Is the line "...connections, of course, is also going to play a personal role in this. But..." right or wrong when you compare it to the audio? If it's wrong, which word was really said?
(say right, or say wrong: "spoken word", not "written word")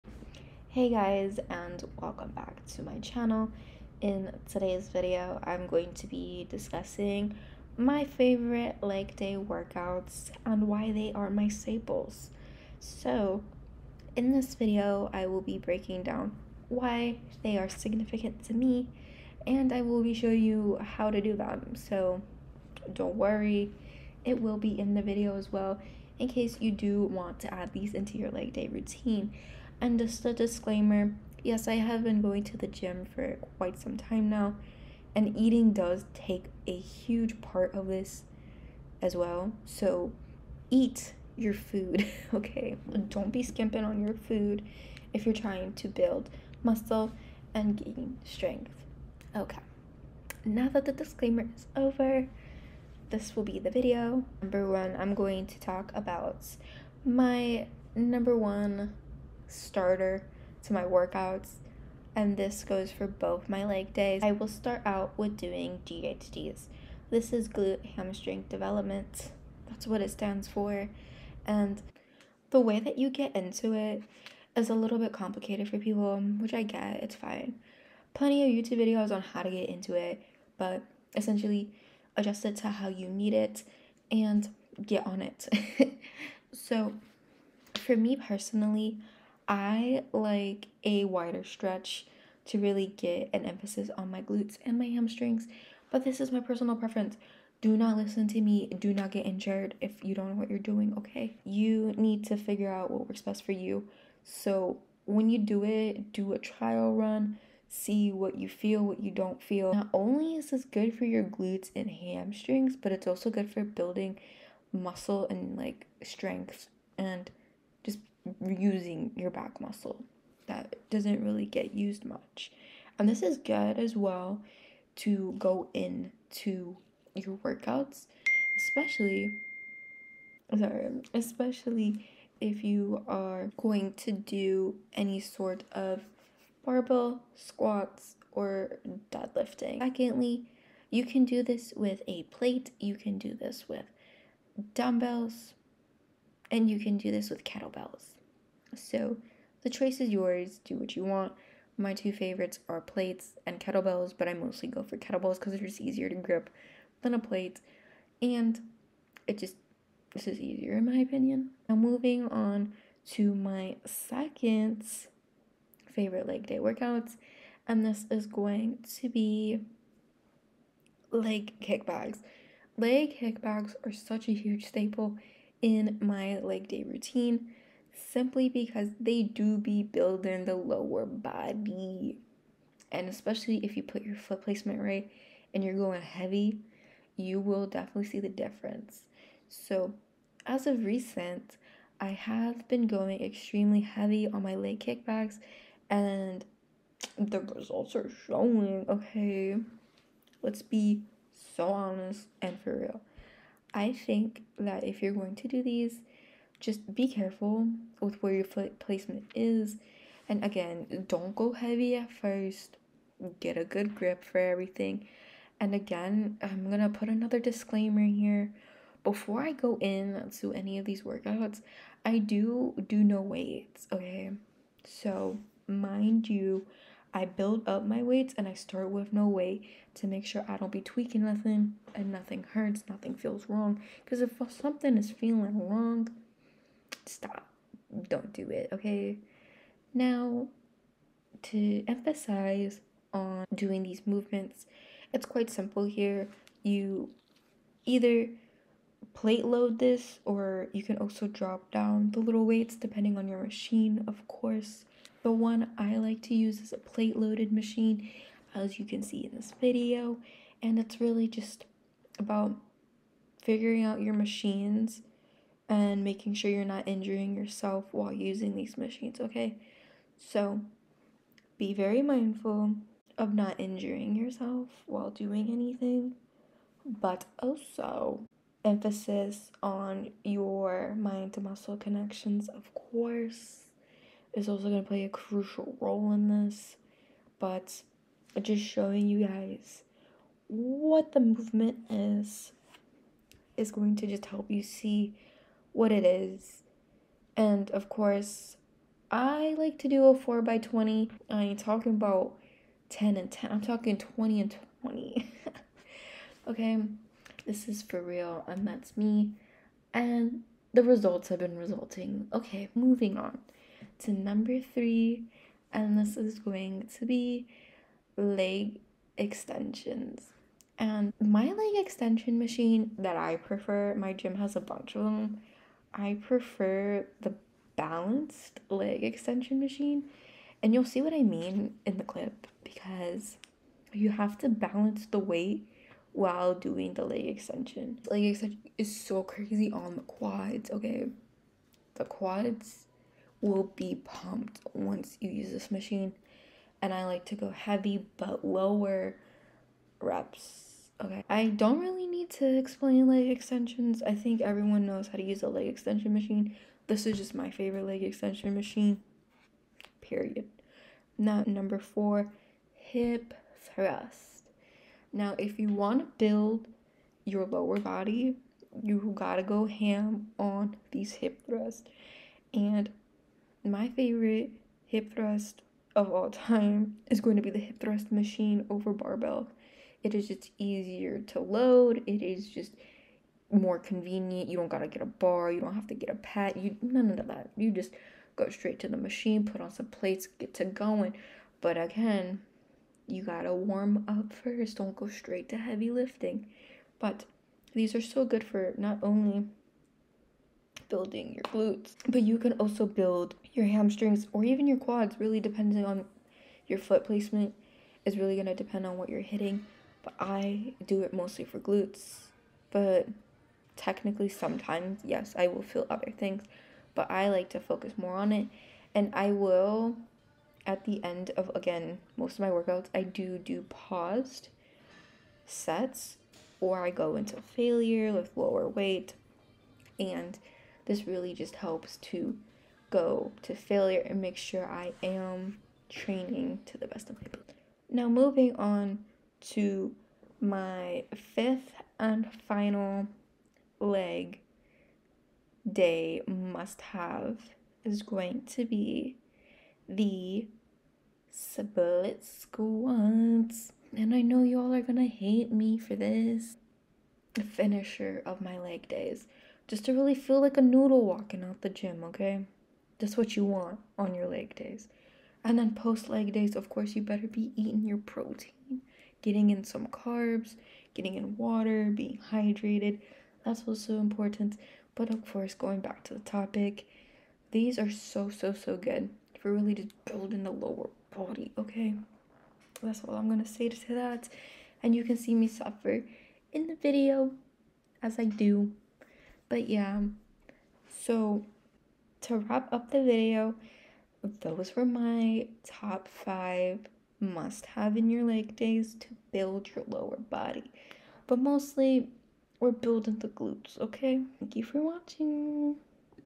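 wrong: "crucial", not "personal".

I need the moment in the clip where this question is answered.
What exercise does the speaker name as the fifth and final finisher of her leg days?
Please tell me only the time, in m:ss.
7:31.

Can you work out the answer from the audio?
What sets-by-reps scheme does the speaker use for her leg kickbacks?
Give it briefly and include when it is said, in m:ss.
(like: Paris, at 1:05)
4 by 20, at 5:00.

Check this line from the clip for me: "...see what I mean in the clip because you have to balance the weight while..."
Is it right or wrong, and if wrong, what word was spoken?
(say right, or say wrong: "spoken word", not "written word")
right.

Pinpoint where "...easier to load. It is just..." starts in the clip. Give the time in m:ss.
6:20.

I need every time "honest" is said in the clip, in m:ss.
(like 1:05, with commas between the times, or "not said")
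3:21.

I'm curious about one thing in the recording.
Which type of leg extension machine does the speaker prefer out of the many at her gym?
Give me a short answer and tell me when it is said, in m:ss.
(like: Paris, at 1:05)
balanced leg extension machine, at 5:27.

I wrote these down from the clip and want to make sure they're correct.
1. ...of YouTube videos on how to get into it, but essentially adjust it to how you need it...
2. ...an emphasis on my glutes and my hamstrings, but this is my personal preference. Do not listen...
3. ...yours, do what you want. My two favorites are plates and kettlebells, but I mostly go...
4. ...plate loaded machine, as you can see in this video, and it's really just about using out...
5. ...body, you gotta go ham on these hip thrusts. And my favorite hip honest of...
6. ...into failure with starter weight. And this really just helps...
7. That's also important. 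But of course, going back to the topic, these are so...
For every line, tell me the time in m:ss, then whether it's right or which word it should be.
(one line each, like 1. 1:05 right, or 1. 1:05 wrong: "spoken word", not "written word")
1. 1:18 right
2. 1:33 right
3. 2:30 right
4. 4:16 wrong: "figuring", not "using"
5. 6:07 wrong: "thrust", not "honest"
6. 7:07 wrong: "lower", not "starter"
7. 7:53 right.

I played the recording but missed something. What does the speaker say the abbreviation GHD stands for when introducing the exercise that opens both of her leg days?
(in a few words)
glute hamstring development.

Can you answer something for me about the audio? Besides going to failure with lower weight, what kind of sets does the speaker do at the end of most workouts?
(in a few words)
paused sets.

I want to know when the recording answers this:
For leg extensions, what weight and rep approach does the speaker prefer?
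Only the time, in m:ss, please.
5:47.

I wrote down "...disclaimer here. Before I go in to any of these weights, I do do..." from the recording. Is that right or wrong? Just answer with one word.
wrong.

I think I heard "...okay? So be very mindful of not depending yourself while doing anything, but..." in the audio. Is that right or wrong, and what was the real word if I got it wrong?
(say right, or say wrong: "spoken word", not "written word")
wrong: "injuring", not "depending".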